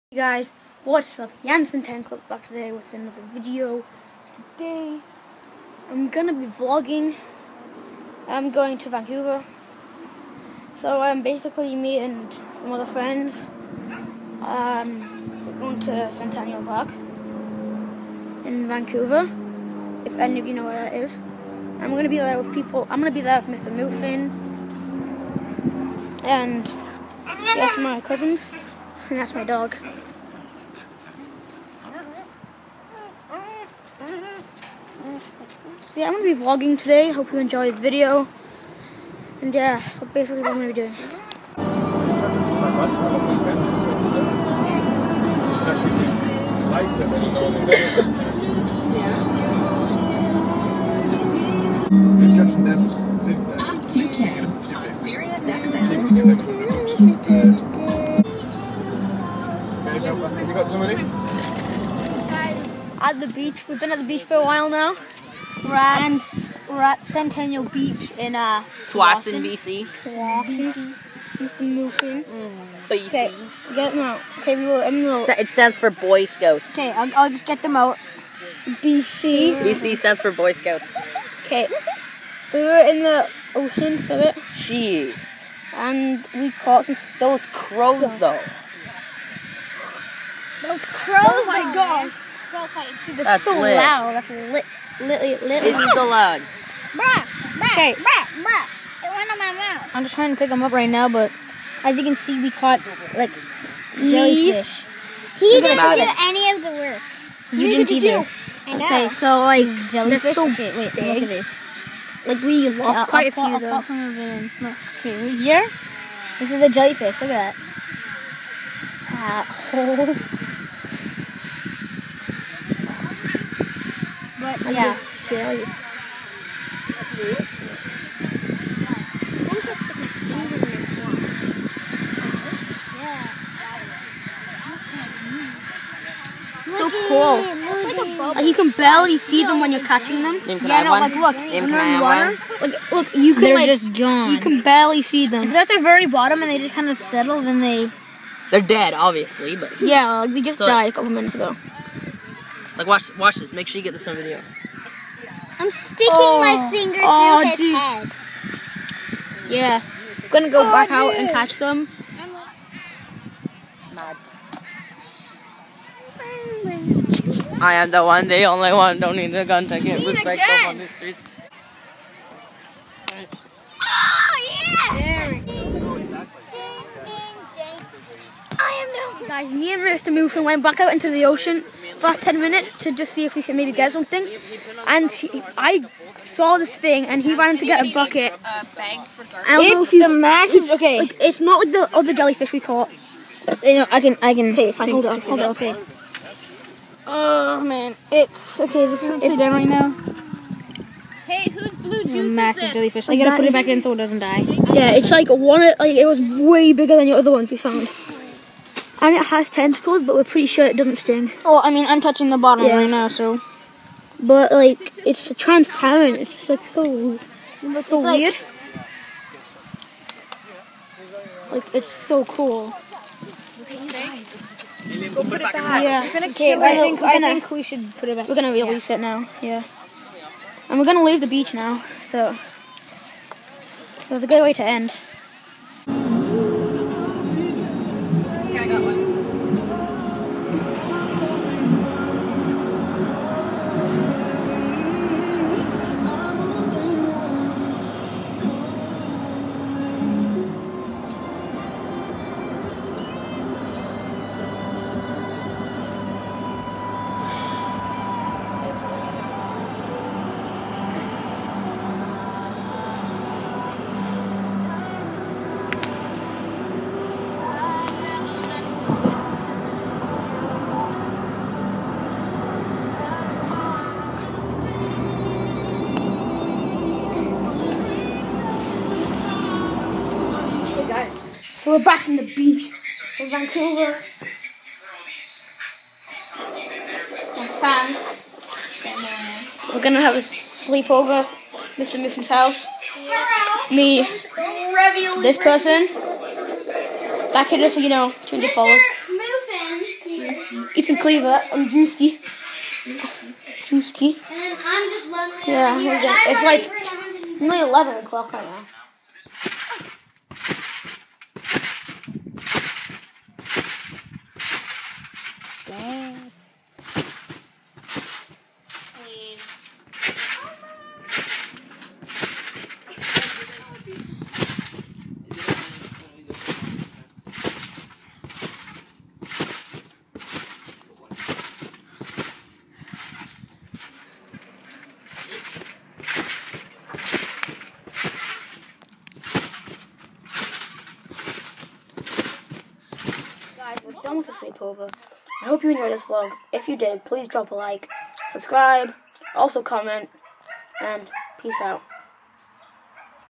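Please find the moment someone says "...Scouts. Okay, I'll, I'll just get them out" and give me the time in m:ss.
1:16.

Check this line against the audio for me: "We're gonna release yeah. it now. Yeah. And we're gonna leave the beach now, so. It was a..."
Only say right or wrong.
right.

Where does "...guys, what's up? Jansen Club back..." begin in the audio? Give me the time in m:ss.
0:00.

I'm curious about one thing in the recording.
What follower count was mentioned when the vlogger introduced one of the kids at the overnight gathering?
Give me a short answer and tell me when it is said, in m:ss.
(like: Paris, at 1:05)
200, at 4:58.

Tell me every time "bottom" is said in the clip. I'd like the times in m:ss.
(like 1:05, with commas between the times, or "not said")
2:26, 3:32.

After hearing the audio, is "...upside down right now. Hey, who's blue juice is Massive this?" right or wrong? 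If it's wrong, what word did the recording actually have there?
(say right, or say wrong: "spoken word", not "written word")
right.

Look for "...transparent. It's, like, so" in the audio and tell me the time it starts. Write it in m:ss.
3:35.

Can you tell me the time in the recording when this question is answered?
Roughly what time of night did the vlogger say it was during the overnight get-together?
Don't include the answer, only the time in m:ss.
5:07.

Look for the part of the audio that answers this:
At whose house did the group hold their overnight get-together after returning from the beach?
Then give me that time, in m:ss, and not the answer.
4:51.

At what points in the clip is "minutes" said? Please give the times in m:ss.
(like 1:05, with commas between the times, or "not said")
2:31, 3:02.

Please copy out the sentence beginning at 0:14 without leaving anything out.
Um, we're going to Centennial Park in Vancouver.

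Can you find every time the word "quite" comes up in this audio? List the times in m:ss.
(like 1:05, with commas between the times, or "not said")
1:53.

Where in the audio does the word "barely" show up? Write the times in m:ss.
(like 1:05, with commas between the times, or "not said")
2:18, 2:24.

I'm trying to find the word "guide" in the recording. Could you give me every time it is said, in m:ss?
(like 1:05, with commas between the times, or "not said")
not said.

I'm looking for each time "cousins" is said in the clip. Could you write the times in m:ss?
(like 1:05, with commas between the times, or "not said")
0:28.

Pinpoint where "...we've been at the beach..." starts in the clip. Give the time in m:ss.
1:03.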